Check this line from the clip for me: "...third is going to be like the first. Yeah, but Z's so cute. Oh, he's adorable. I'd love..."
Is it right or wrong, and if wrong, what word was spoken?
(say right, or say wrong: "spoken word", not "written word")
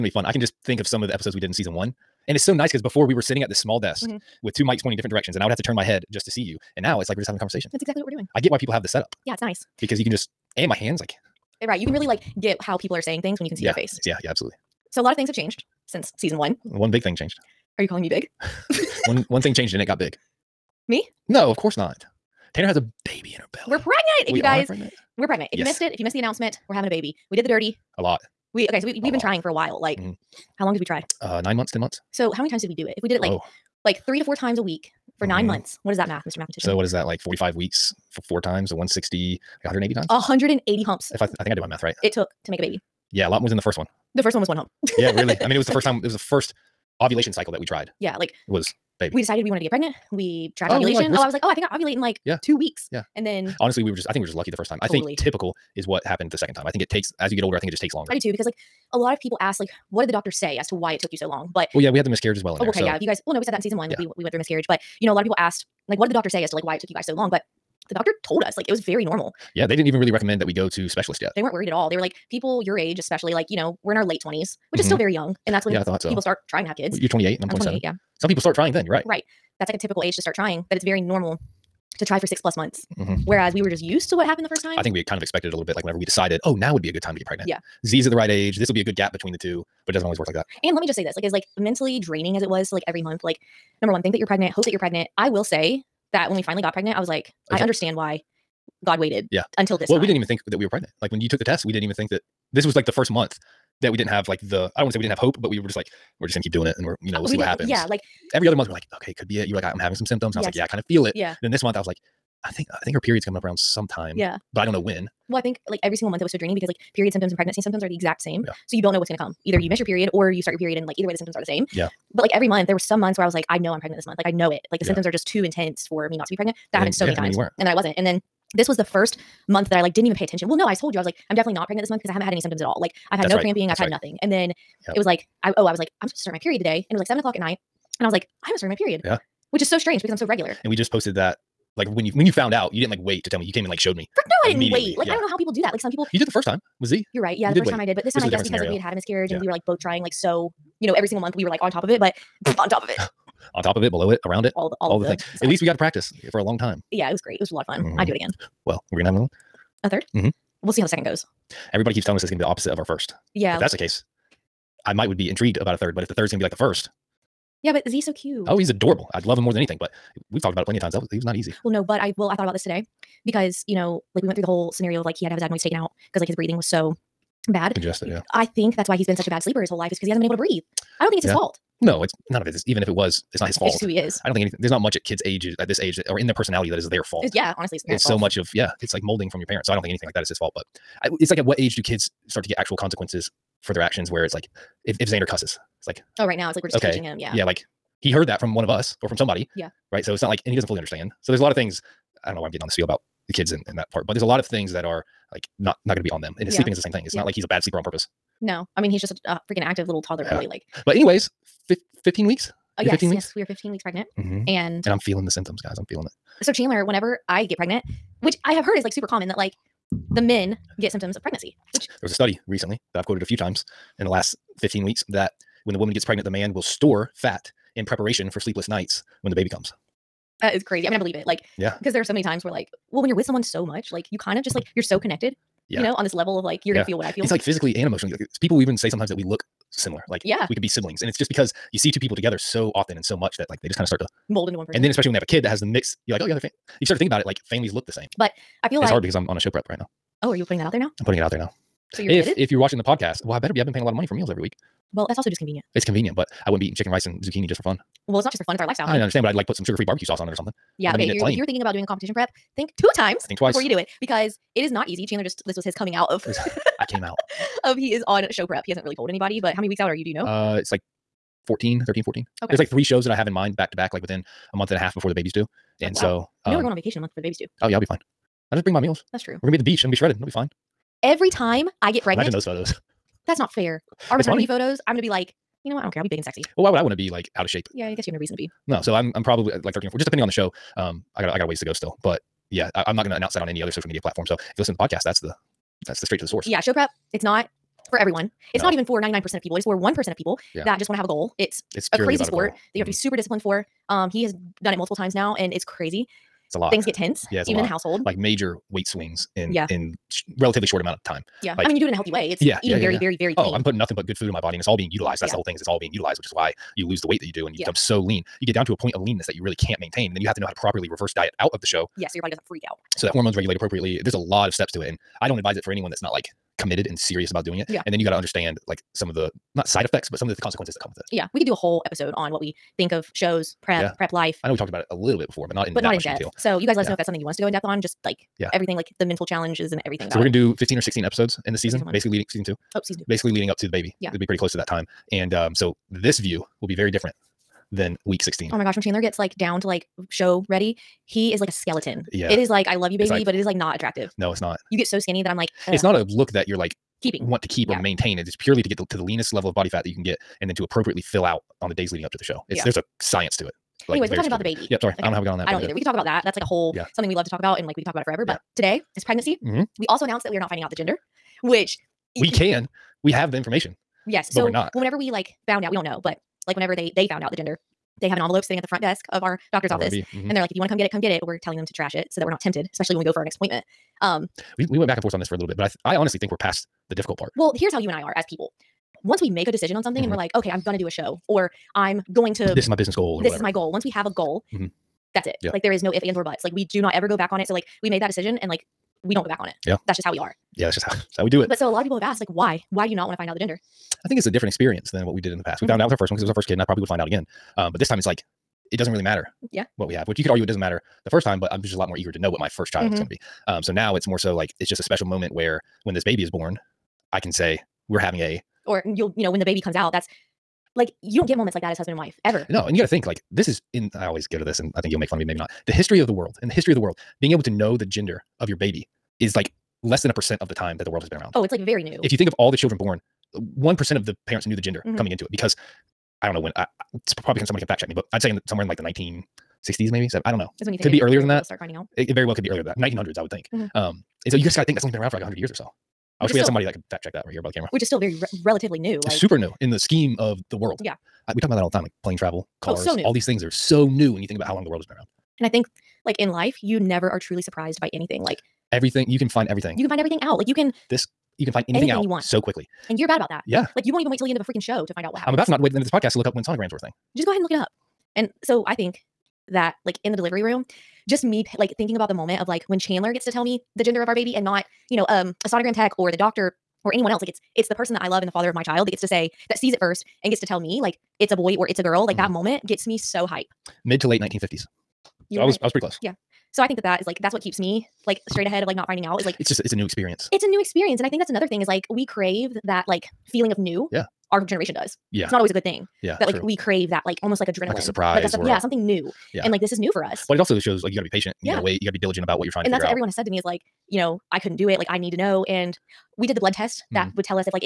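right.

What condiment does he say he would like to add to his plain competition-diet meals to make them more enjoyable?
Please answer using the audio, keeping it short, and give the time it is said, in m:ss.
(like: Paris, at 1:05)
sugar-free barbecue sauce, at 4:19.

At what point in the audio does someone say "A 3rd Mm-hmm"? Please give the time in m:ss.
2:39.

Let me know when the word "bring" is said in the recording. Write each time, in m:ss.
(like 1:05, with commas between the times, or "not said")
4:38.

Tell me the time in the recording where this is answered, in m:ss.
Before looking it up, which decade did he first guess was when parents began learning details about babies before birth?
7:18.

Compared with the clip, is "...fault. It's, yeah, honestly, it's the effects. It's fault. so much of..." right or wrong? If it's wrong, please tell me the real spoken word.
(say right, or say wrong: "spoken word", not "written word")
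wrong: "parents", not "effects".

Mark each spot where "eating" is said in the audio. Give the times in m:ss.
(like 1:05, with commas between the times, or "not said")
4:16, 5:12.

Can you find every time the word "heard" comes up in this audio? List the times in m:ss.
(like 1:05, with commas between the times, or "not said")
3:18, 3:38.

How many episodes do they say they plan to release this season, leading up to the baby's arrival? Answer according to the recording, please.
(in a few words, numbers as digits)
15 or 16.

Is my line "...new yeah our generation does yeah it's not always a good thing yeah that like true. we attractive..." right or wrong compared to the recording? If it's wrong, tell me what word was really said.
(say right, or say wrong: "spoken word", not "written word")
wrong: "crave", not "attractive".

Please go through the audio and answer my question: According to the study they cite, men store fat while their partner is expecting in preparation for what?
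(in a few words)
sleepless nights.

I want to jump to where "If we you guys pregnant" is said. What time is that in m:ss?
0:24.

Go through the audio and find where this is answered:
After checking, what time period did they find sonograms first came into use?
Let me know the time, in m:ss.
8:03.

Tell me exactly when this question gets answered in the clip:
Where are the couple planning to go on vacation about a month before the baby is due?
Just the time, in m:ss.
4:39.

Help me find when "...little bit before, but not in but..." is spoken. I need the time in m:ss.
5:34.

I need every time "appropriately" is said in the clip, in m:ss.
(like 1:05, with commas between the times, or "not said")
5:23, 6:00.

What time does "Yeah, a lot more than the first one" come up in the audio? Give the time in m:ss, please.
0:43.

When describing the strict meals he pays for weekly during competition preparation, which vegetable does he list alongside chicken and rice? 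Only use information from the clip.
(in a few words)
zucchini.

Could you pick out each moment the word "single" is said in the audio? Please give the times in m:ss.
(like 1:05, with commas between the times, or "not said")
1:55, 2:31.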